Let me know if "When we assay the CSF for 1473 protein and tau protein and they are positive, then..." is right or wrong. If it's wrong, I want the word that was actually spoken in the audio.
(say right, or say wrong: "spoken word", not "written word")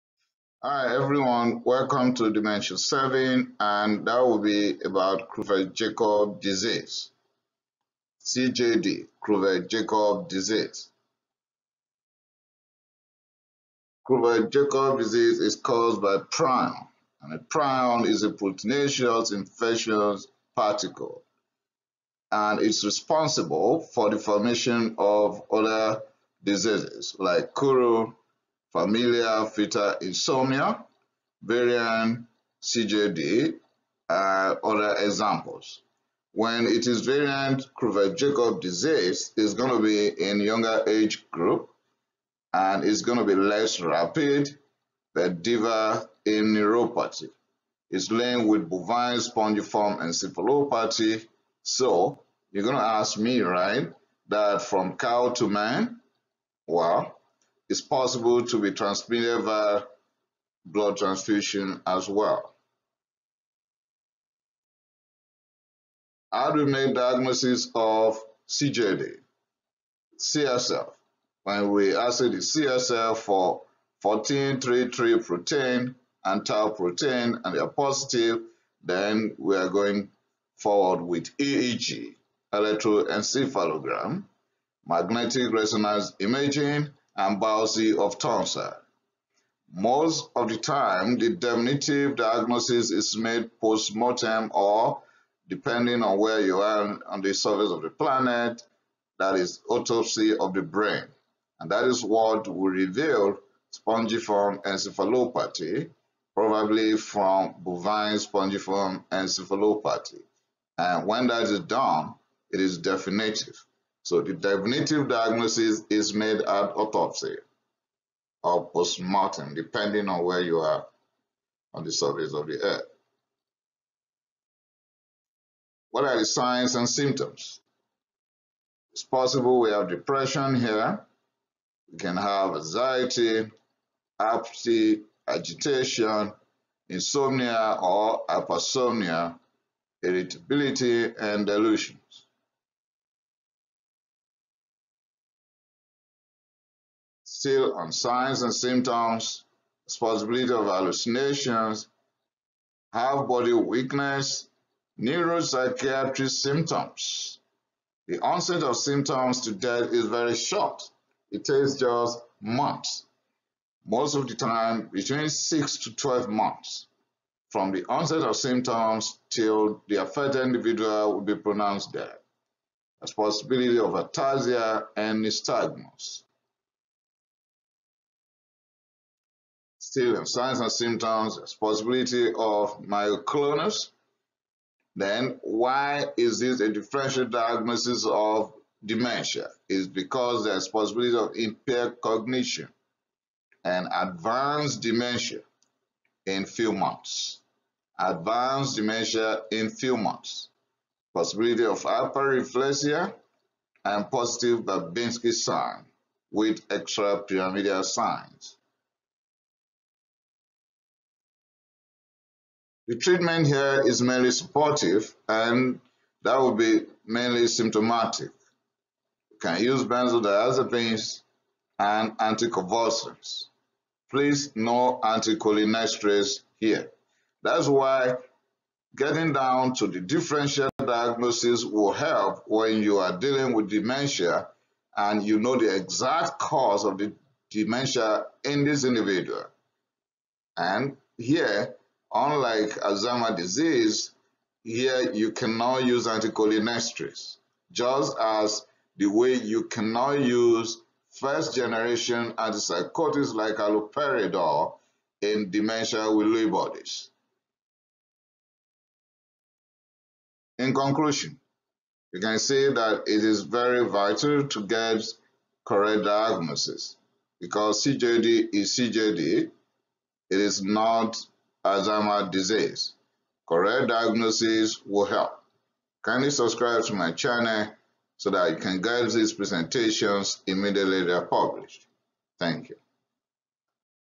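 wrong: "1433", not "1473".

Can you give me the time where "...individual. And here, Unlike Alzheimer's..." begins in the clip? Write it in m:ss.
3:58.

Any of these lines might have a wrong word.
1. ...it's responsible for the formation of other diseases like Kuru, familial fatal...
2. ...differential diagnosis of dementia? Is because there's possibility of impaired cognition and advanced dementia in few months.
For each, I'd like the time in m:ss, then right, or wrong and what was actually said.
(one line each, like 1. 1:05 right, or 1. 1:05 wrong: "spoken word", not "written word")
1. 0:22 right
2. 3:06 right.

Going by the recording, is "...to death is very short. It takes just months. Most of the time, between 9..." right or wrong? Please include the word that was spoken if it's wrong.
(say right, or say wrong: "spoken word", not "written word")
wrong: "6", not "9".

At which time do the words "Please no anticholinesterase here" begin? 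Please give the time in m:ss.
3:44.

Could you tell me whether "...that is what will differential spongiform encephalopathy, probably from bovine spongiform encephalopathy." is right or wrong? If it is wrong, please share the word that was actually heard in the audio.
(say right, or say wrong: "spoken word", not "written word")
wrong: "reveal", not "differential".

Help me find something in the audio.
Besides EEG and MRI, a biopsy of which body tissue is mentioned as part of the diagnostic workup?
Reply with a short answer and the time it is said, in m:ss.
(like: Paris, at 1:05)
Tonsil, at 1:28.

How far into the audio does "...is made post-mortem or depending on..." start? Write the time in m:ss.
1:32.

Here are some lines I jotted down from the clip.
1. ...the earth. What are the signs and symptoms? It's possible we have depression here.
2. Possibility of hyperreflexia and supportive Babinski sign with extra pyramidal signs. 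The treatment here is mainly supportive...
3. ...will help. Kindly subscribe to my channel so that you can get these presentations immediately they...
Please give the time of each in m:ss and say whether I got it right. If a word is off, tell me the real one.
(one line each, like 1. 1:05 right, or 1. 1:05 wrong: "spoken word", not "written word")
1. 2:02 right
2. 3:21 wrong: "positive", not "supportive"
3. 4:34 right.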